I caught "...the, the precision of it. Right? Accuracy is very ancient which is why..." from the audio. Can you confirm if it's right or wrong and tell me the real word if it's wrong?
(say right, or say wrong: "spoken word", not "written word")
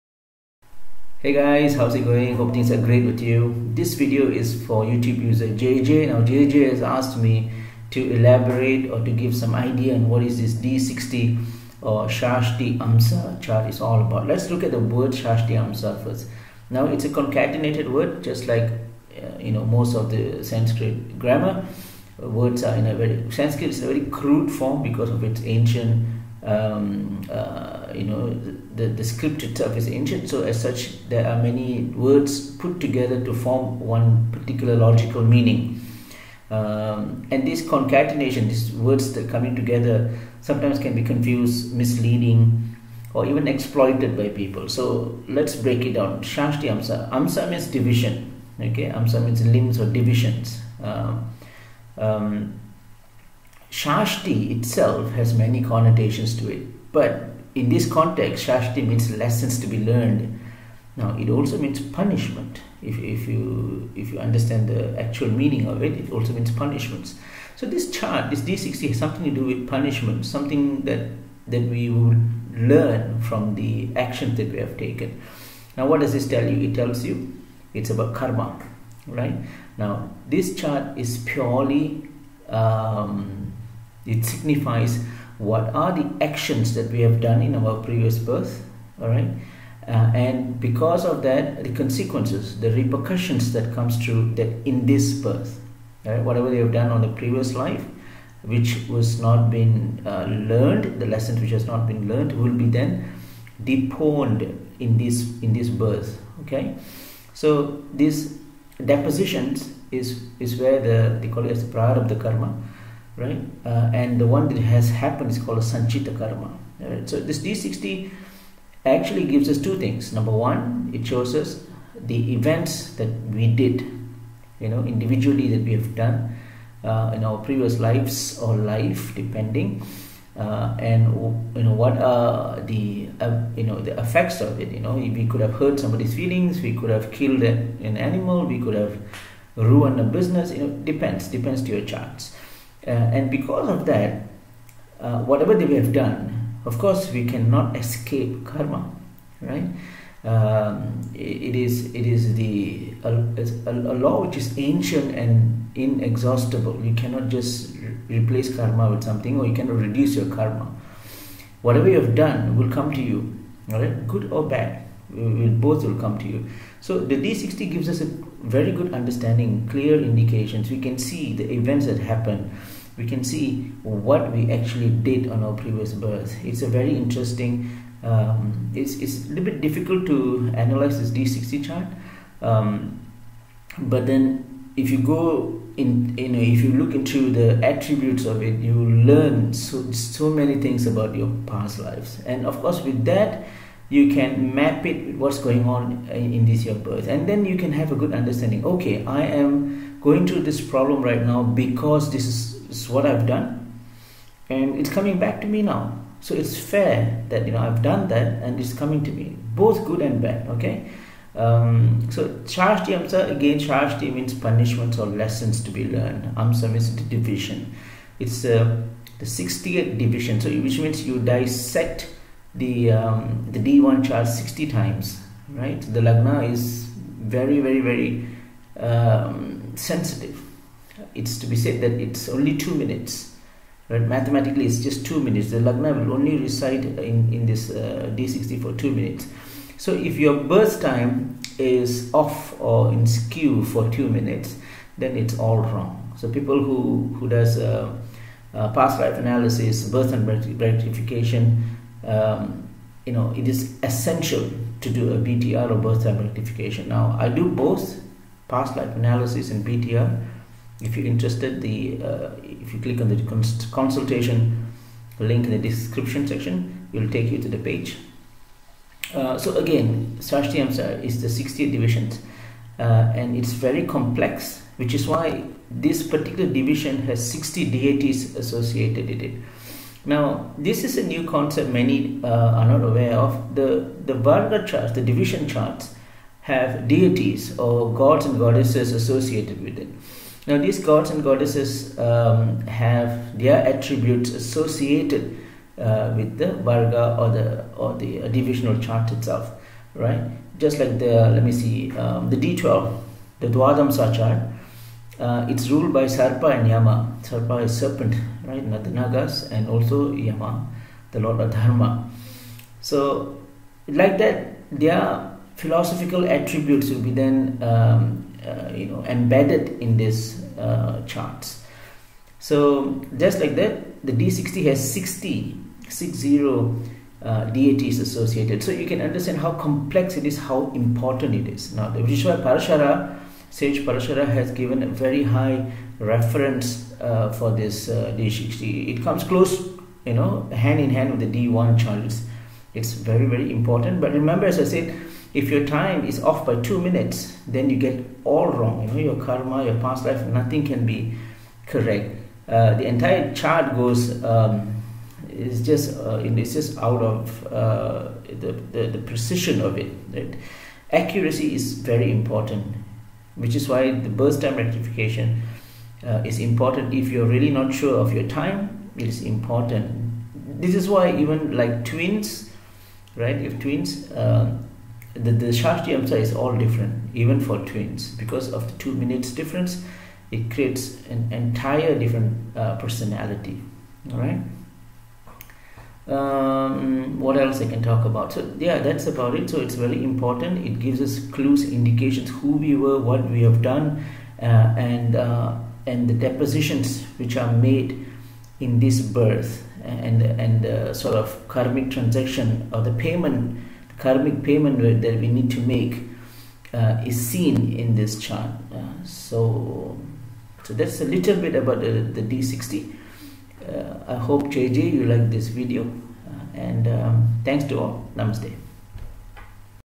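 wrong: "important", not "ancient".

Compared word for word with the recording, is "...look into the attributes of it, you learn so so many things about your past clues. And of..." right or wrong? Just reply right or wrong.
wrong.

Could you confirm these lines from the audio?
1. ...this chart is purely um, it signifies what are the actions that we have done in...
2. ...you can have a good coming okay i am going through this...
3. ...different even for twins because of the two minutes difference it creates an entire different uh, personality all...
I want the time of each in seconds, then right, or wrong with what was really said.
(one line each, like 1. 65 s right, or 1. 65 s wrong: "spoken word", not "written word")
1. 80 s right
2. 197 s wrong: "understanding", not "coming"
3. 376 s right.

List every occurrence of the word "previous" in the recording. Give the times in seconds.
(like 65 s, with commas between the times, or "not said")
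87 s, 97 s, 127 s, 175 s.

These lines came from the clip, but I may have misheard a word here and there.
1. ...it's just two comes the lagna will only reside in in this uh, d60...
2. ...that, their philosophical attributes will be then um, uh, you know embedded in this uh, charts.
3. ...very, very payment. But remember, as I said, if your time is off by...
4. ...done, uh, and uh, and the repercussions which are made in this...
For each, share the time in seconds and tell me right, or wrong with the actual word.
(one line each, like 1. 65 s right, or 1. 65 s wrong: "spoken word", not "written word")
1. 234 s wrong: "minutes", not "comes"
2. 314 s right
3. 342 s wrong: "important", not "payment"
4. 393 s wrong: "depositions", not "repercussions".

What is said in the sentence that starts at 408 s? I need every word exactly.
Uh, so so that's a little bit about the, the D60.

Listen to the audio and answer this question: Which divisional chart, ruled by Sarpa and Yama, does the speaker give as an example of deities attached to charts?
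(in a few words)
D12 (Dwadamsa).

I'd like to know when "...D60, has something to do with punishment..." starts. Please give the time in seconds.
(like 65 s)
68 s.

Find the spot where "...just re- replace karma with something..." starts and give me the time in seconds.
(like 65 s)
157 s.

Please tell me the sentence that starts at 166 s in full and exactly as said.
So the D60 gives us a very good understanding, clear indications.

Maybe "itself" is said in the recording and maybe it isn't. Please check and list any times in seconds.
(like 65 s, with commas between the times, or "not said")
29 s, 54 s, 299 s.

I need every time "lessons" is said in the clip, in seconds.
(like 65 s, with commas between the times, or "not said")
59 s, 101 s, 215 s.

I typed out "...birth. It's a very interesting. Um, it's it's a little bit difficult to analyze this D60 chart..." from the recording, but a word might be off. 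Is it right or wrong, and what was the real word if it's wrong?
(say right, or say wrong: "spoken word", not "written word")
right.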